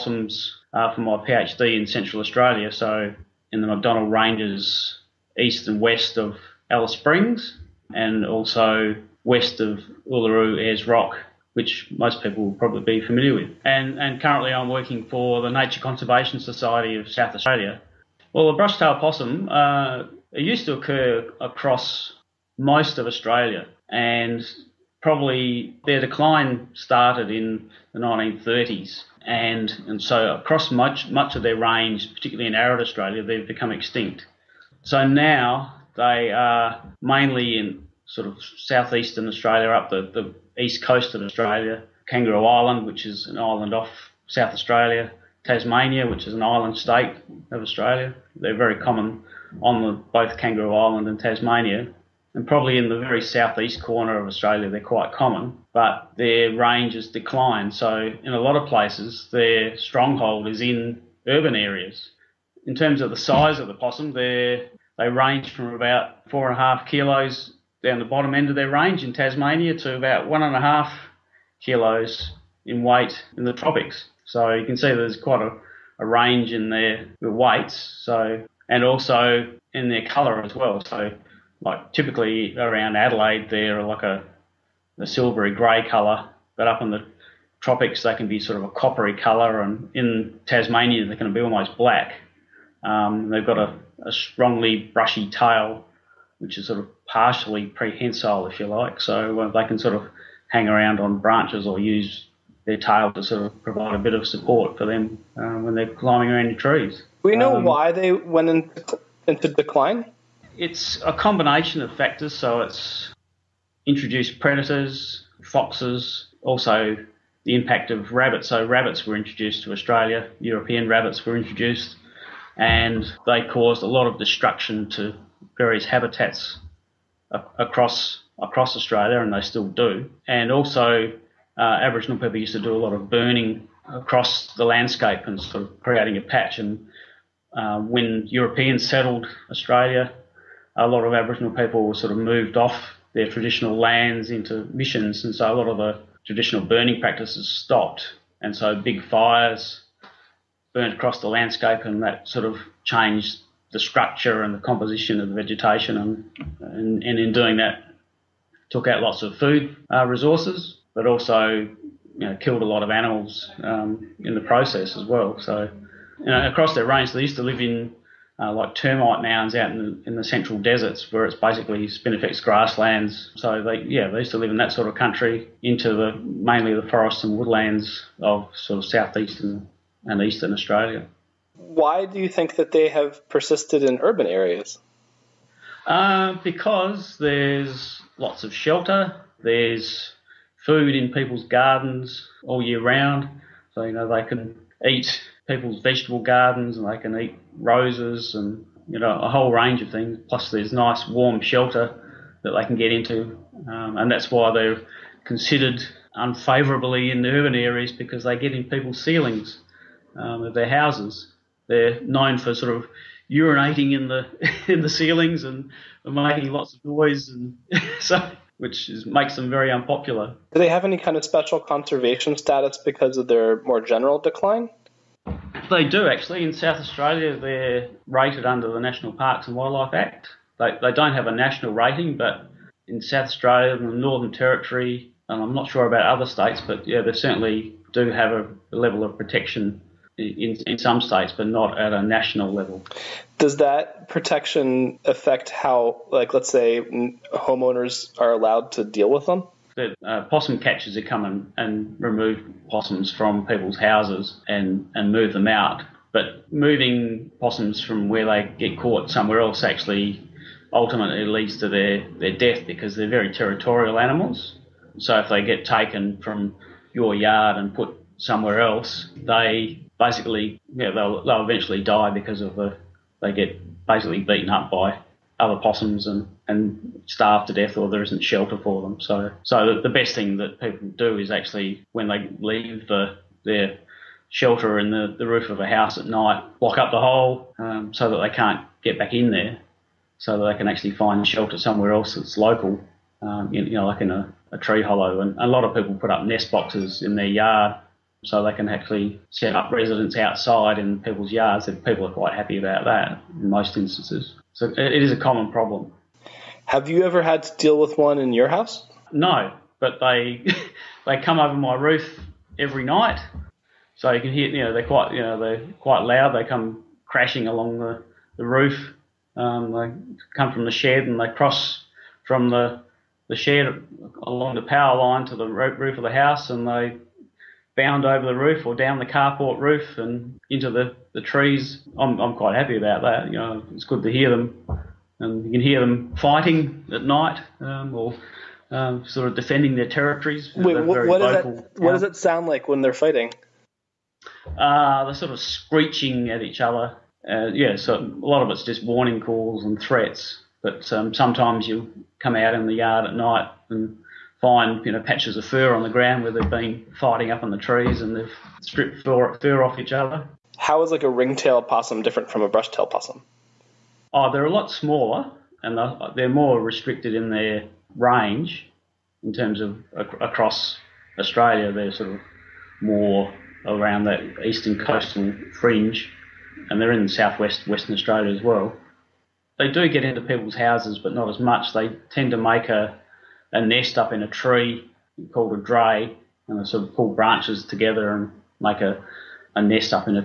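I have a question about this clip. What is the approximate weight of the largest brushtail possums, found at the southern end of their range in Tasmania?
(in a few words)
4.5 kilos.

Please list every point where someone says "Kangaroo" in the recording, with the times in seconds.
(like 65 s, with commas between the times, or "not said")
42 s, 50 s.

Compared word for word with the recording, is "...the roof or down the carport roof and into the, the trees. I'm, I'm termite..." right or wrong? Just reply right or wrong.
wrong.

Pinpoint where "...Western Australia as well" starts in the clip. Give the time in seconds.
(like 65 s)
377 s.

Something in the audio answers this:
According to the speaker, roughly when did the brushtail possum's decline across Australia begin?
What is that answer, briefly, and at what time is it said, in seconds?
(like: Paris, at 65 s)
1930s, at 27 s.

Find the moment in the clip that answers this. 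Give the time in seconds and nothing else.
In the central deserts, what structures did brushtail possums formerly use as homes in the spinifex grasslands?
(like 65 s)
168 s.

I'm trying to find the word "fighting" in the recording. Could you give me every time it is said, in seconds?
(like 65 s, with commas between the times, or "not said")
336 s, 342 s, 356 s.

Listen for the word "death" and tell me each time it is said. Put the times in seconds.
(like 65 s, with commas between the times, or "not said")
262 s, 277 s.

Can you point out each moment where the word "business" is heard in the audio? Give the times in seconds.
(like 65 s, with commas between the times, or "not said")
not said.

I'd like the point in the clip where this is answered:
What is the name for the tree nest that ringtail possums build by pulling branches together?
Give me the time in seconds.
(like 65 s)
385 s.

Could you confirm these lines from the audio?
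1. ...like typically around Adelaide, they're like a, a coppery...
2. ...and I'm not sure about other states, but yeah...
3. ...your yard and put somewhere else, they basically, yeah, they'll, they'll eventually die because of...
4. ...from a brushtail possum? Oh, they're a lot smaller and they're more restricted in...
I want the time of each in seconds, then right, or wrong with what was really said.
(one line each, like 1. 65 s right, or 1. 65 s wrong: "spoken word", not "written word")
1. 81 s wrong: "silvery", not "coppery"
2. 235 s right
3. 266 s right
4. 362 s right.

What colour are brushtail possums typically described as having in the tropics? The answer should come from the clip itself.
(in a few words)
Coppery.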